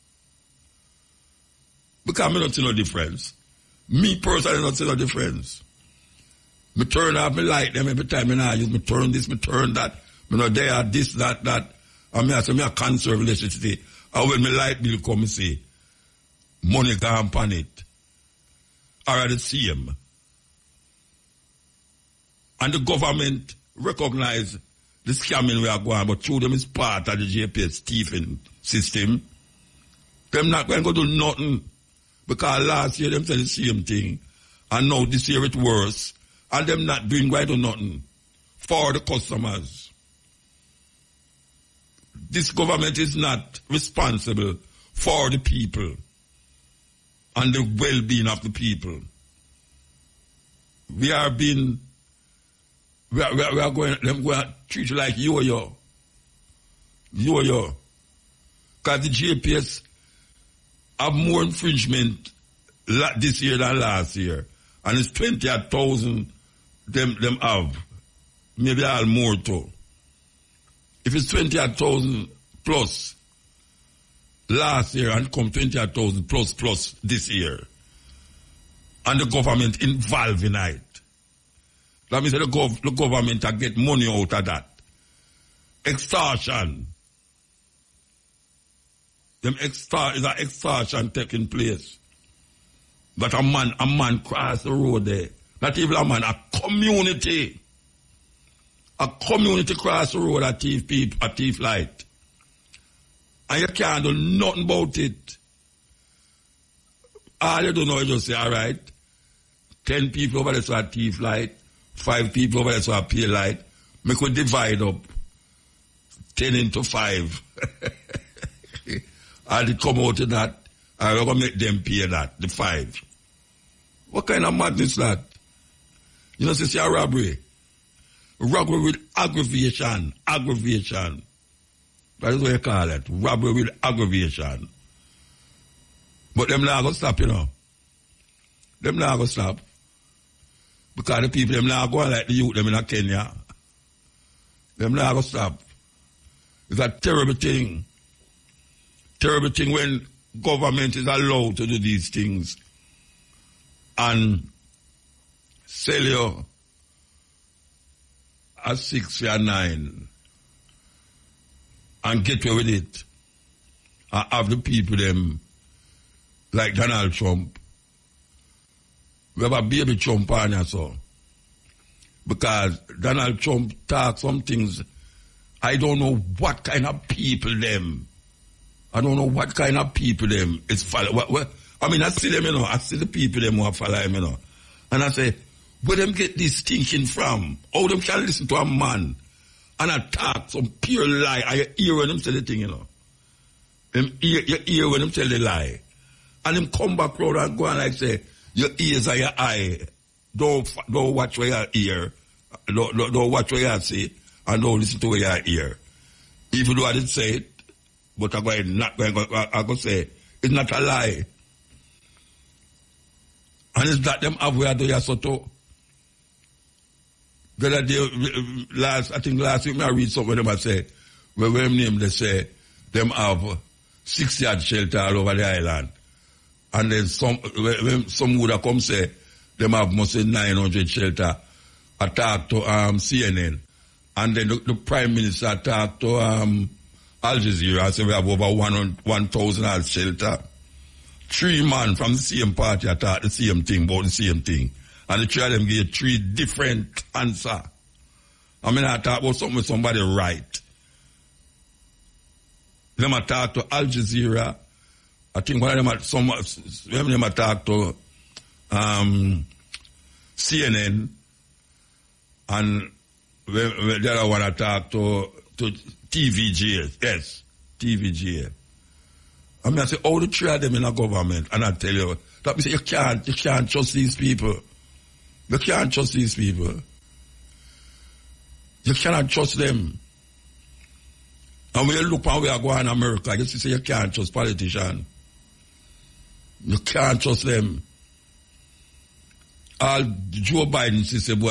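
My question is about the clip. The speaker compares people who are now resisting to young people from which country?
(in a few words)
Kenya.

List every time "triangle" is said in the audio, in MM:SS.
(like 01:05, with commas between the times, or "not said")
not said.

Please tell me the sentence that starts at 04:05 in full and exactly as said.
And the three of them gave three different answer.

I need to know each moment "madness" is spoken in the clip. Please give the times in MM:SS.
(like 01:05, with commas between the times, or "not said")
02:04.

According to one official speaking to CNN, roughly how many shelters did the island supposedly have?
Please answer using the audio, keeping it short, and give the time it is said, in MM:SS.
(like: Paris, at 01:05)
900, at 03:50.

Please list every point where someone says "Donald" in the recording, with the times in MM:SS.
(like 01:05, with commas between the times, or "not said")
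02:46, 02:52.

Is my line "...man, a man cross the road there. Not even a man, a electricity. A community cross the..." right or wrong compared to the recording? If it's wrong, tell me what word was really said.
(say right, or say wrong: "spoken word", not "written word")
wrong: "community", not "electricity".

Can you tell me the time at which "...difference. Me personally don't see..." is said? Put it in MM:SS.
00:02.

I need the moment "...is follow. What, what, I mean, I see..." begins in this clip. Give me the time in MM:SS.
03:00.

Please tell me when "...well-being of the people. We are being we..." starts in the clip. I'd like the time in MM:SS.
00:47.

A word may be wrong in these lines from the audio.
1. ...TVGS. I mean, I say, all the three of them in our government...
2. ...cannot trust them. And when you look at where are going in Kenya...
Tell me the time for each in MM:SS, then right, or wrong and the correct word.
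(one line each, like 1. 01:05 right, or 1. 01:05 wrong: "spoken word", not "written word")
1. 04:27 right
2. 04:38 wrong: "America", not "Kenya".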